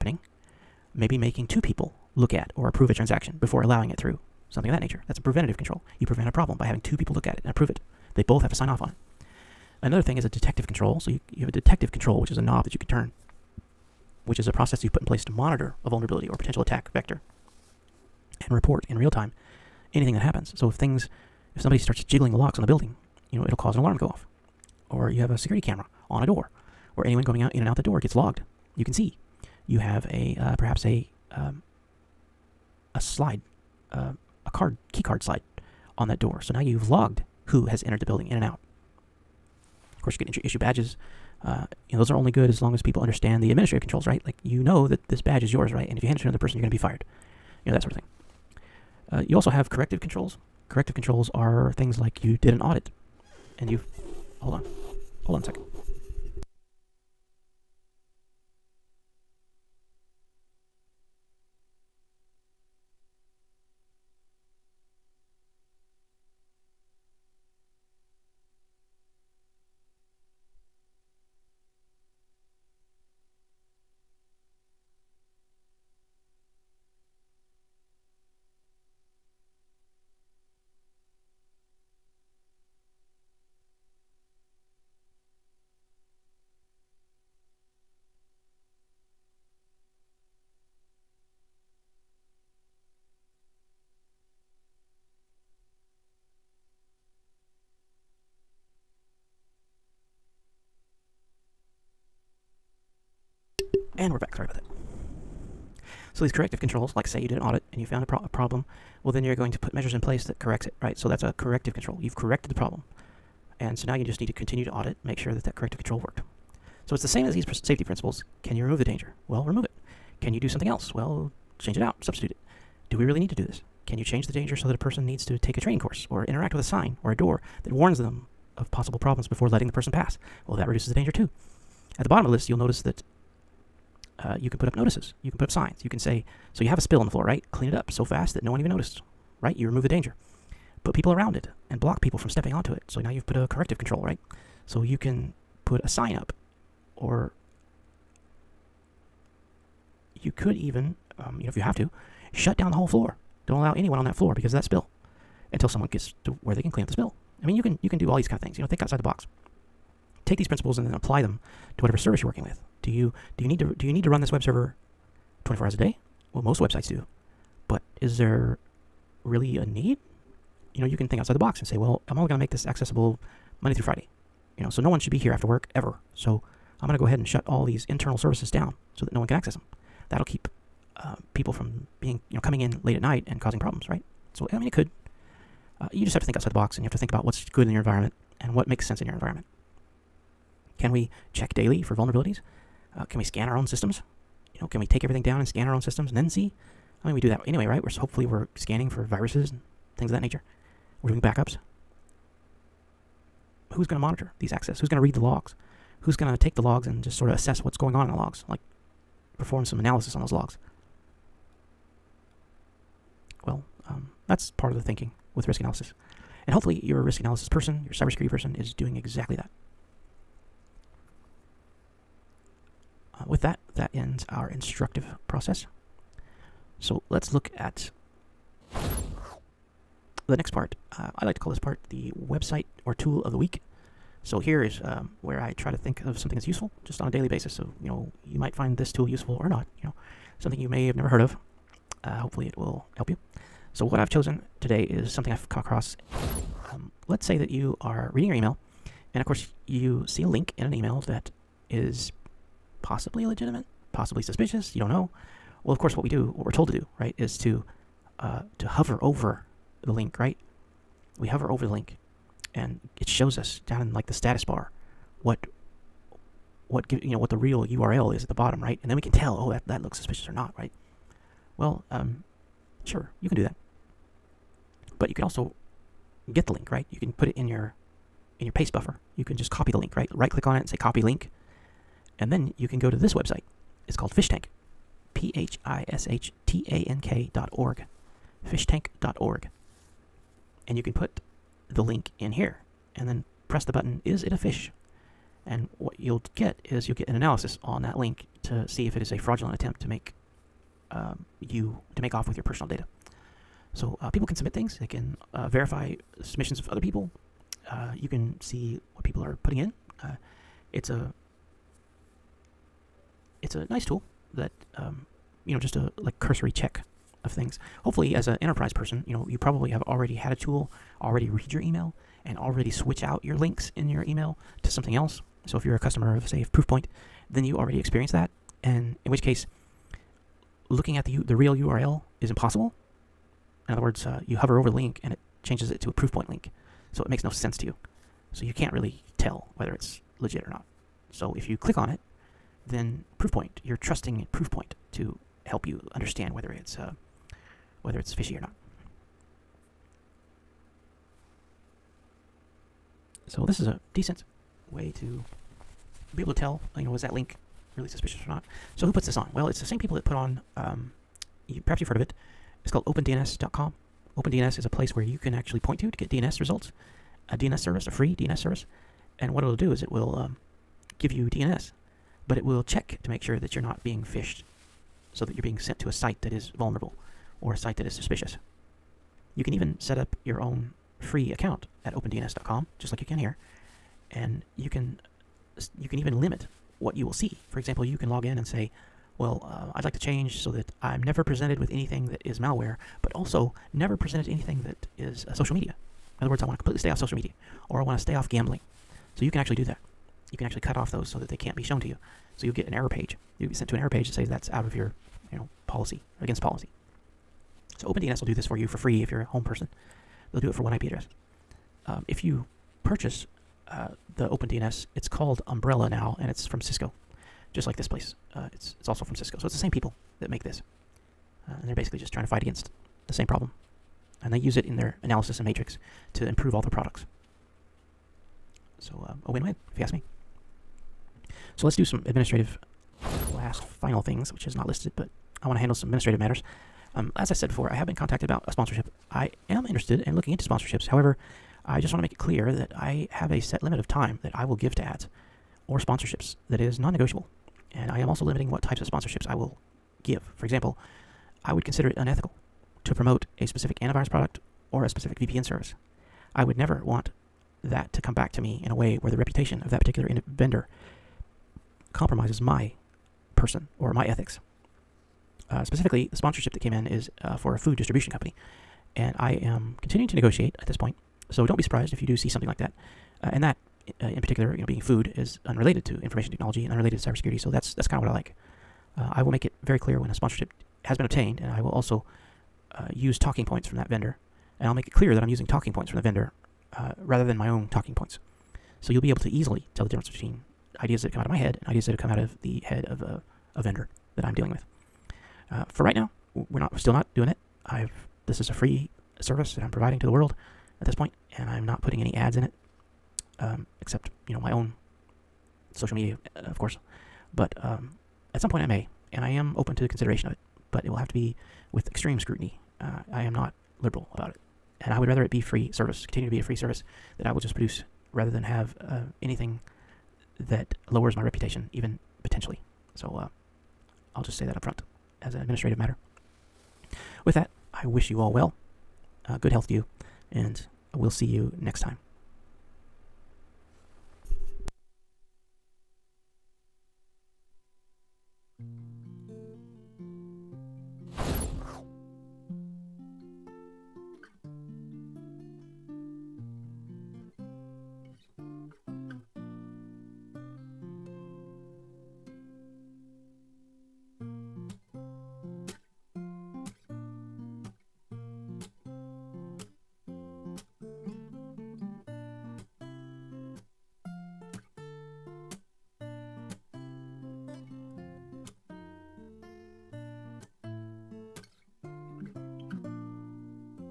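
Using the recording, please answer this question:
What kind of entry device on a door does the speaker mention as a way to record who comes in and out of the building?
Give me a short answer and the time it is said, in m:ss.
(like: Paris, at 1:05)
key card slide, at 0:34.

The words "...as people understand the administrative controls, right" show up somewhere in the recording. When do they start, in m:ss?
0:42.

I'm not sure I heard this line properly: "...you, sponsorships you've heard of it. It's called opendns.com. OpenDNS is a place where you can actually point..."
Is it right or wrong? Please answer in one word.
wrong.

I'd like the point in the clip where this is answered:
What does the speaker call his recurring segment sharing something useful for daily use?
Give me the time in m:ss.
3:52.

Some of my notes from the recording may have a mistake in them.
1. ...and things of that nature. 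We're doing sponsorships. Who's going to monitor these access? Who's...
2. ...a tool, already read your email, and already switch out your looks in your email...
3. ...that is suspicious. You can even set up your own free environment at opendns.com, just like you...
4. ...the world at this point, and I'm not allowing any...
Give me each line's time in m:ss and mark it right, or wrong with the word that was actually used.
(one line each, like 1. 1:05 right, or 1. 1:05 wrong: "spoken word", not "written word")
1. 3:19 wrong: "backups", not "sponsorships"
2. 5:20 wrong: "links", not "looks"
3. 6:17 wrong: "account", not "environment"
4. 8:20 wrong: "putting", not "allowing".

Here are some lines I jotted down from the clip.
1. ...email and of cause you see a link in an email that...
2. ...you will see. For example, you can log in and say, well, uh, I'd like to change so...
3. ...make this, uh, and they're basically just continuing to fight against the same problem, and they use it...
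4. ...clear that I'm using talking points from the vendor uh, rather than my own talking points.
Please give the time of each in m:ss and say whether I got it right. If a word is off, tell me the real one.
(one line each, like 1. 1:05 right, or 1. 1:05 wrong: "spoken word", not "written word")
1. 4:08 wrong: "course", not "cause"
2. 6:26 right
3. 7:00 wrong: "trying", not "continuing"
4. 8:04 right.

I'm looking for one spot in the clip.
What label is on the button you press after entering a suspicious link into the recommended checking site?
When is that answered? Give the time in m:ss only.
4:54.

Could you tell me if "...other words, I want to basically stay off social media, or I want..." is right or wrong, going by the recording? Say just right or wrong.
wrong.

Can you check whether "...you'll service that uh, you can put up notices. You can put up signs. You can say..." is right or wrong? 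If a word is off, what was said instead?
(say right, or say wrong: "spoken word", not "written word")
wrong: "notice", not "service".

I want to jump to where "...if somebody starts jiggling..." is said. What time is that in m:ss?
0:21.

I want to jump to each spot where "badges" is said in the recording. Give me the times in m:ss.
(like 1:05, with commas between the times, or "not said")
0:40, 0:45.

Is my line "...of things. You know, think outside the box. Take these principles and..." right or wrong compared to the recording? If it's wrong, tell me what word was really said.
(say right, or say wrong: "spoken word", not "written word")
right.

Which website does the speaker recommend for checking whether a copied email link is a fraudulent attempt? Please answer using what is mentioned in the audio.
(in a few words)
PhishTank.org.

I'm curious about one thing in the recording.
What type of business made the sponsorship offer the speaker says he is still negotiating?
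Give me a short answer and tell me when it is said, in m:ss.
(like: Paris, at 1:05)
food distribution company, at 7:47.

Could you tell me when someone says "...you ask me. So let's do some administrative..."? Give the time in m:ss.
7:09.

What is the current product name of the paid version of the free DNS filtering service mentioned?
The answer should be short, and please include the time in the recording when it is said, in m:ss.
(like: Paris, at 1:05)
Umbrella, at 6:55.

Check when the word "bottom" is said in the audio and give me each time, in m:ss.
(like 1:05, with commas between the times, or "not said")
2:12, 4:28.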